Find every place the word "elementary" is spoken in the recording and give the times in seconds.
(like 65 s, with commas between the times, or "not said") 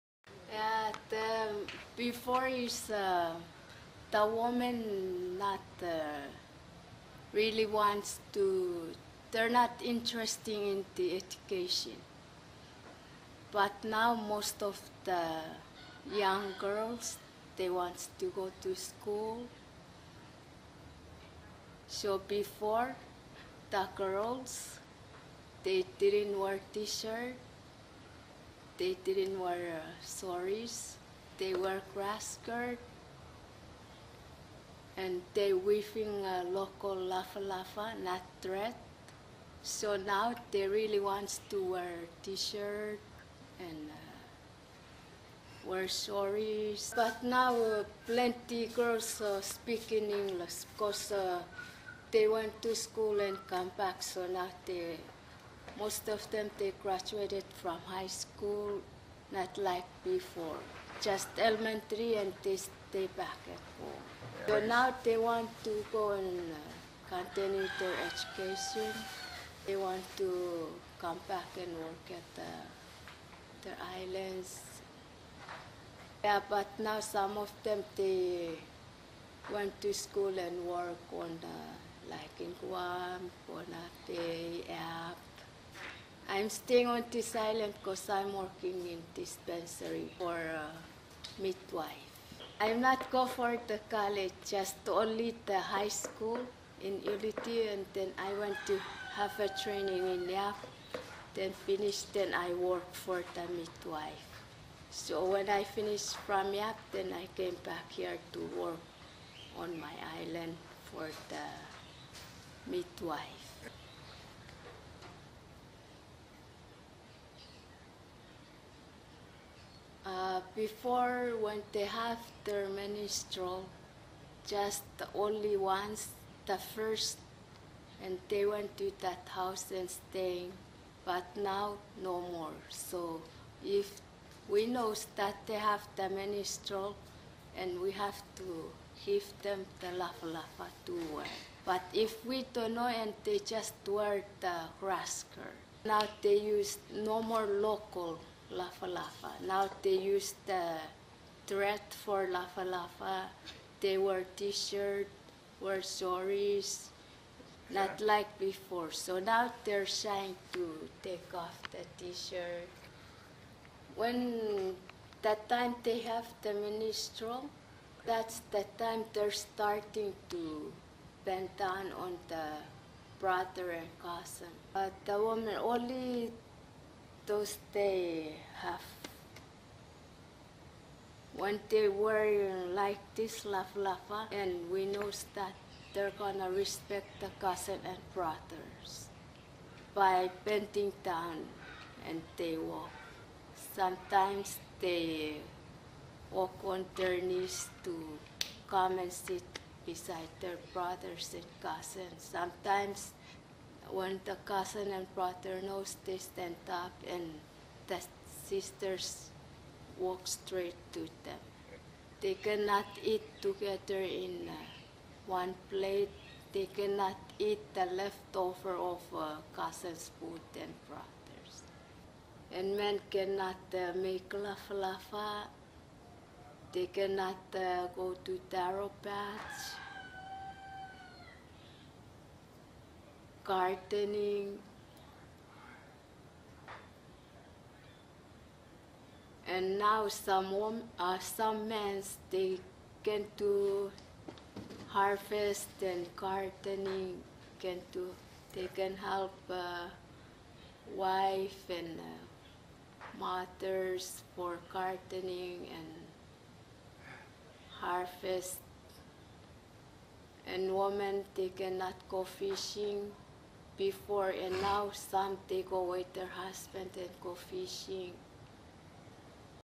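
61 s.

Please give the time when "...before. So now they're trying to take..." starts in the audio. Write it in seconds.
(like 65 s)
158 s.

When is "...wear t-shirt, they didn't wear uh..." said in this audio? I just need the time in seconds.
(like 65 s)
26 s.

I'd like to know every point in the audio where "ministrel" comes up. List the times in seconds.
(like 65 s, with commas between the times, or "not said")
166 s.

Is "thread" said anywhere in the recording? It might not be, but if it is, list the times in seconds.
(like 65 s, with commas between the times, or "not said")
38 s, 151 s.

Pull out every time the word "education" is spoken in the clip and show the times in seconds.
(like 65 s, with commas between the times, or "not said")
11 s, 68 s.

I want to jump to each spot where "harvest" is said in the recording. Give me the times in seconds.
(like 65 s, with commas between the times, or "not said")
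244 s, 257 s.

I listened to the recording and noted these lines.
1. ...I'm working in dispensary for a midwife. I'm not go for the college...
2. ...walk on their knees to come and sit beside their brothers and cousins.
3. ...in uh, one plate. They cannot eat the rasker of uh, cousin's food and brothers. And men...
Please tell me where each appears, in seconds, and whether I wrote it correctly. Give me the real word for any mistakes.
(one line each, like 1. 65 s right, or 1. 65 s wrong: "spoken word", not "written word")
1. 88 s right
2. 196 s right
3. 214 s wrong: "leftover", not "rasker".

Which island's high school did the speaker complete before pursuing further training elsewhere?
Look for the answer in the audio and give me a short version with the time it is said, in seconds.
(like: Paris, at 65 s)
Ulithi, at 97 s.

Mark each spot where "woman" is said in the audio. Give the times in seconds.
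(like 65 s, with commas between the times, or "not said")
4 s, 175 s.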